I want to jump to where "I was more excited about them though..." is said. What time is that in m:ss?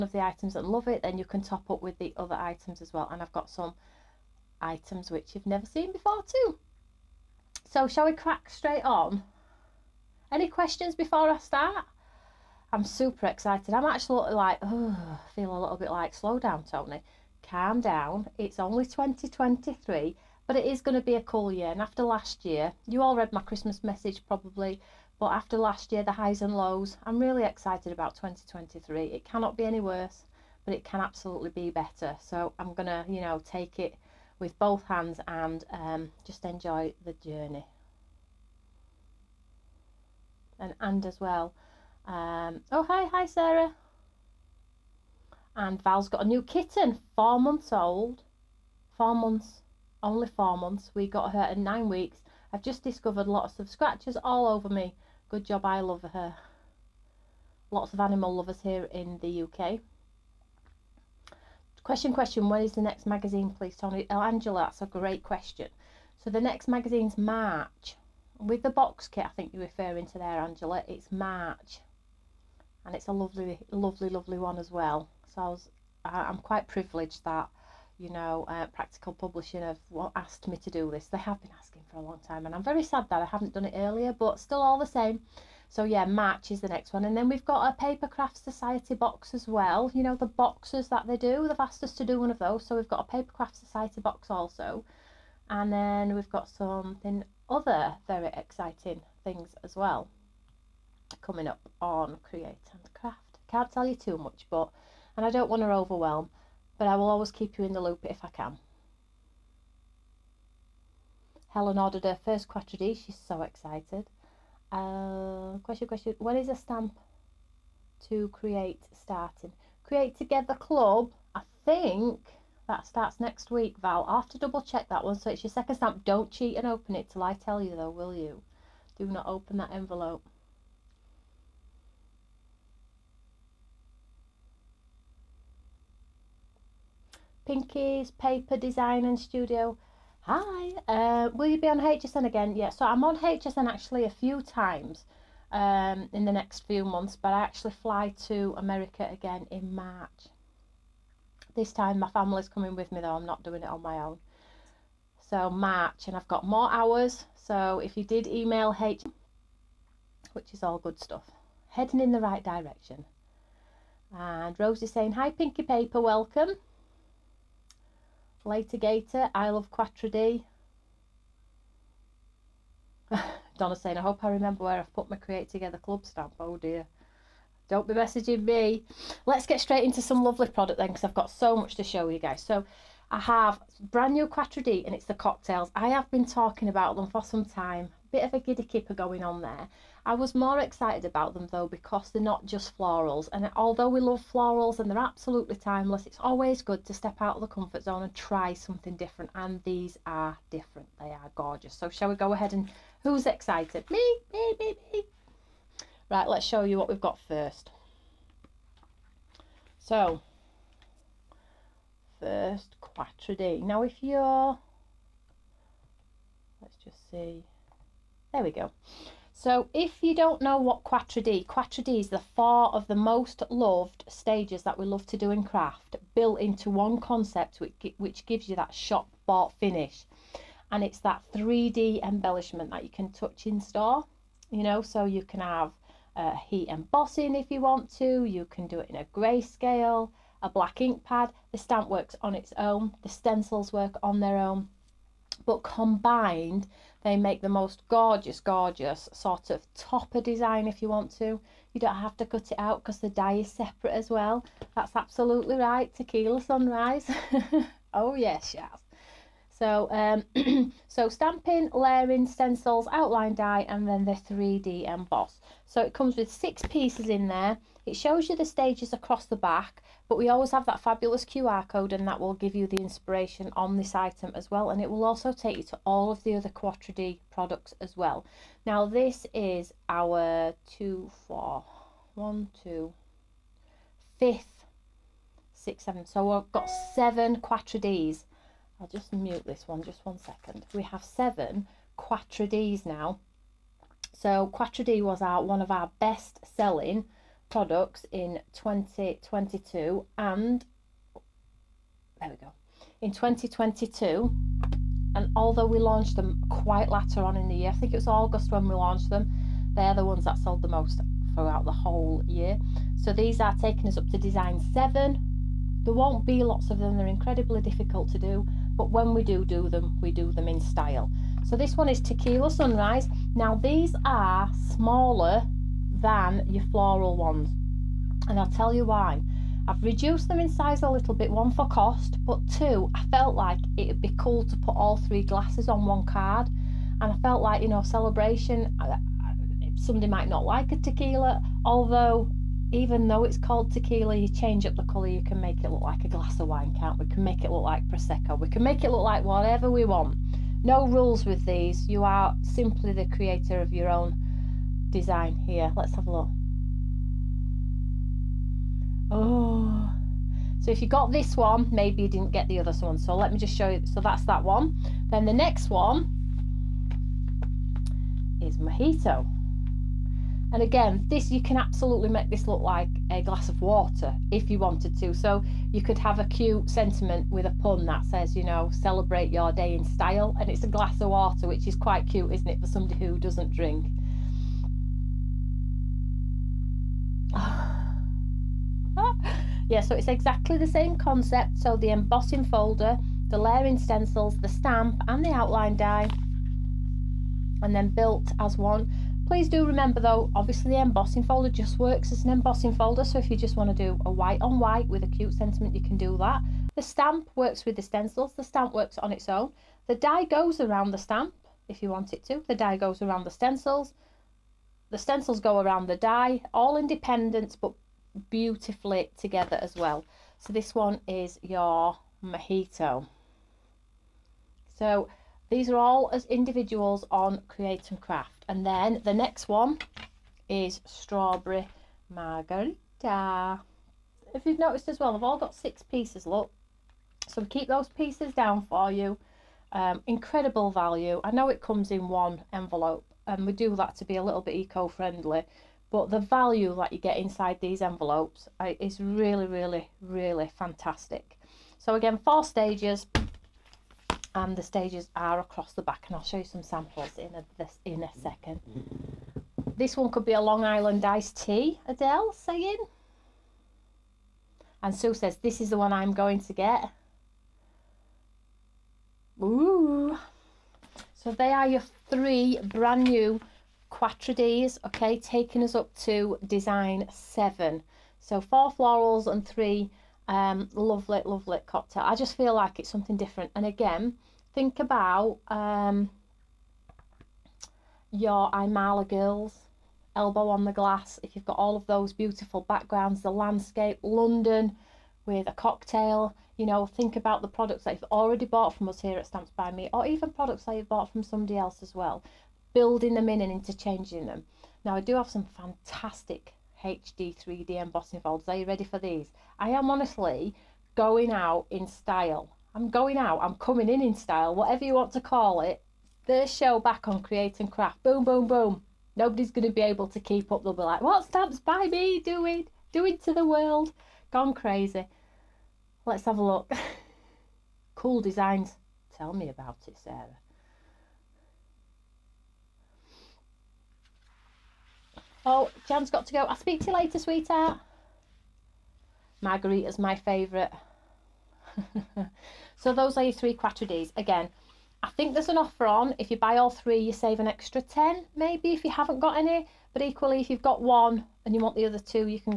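3:10.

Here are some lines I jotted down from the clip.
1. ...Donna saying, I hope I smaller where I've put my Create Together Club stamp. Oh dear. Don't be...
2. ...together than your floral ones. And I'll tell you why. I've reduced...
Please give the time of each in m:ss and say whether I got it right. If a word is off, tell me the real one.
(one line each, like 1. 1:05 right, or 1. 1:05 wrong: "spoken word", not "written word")
1. 2:53 wrong: "remember", not "smaller"
2. 5:24 wrong: "smaller", not "together".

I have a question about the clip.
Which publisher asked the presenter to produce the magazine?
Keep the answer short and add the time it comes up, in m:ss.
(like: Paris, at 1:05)
Practical Publishing, at 1:18.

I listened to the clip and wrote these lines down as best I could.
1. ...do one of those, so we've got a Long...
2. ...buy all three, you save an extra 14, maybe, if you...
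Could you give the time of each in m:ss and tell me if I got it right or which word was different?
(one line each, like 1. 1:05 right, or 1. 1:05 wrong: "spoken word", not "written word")
1. 1:32 wrong: "Paper", not "Long"
2. 9:06 wrong: "10", not "14".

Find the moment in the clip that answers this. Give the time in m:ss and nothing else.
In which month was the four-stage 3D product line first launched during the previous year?
5:08.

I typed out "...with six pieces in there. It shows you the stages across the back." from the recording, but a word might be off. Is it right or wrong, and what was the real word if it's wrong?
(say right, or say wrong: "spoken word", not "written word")
right.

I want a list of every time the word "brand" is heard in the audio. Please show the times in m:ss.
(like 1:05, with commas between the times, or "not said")
3:03, 7:52.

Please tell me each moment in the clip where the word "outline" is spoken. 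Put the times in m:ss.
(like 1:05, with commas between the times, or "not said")
4:22, 6:35.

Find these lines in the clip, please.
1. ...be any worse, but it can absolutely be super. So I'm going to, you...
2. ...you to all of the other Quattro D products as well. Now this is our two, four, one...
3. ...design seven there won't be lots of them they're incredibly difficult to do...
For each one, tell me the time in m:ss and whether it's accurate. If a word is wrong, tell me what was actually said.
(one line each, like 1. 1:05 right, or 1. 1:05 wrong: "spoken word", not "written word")
1. 0:29 wrong: "better", not "super"
2. 4:35 right
3. 5:14 right.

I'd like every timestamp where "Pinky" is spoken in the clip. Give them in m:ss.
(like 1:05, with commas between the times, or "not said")
2:17, 2:45.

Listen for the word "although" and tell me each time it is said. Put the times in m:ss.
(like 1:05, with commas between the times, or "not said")
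3:13, 5:05, 5:41.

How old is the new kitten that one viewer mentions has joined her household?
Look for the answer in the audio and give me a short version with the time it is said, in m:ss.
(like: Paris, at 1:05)
4 months, at 0:47.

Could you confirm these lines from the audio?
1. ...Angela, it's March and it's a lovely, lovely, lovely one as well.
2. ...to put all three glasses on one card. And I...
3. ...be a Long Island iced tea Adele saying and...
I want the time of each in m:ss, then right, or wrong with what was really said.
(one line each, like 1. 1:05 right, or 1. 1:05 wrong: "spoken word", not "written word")
1. 1:10 right
2. 5:34 right
3. 7:40 right.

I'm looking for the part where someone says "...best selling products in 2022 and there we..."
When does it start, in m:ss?
4:55.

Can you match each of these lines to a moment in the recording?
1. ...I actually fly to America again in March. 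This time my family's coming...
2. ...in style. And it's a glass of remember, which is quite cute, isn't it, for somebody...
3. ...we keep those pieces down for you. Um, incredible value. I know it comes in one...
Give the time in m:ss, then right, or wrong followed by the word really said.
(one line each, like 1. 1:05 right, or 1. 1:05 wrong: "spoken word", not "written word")
1. 2:27 right
2. 6:19 wrong: "water", not "remember"
3. 7:17 right.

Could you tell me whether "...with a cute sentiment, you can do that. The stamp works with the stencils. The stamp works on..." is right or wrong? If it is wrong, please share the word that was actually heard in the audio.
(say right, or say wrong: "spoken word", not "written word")
right.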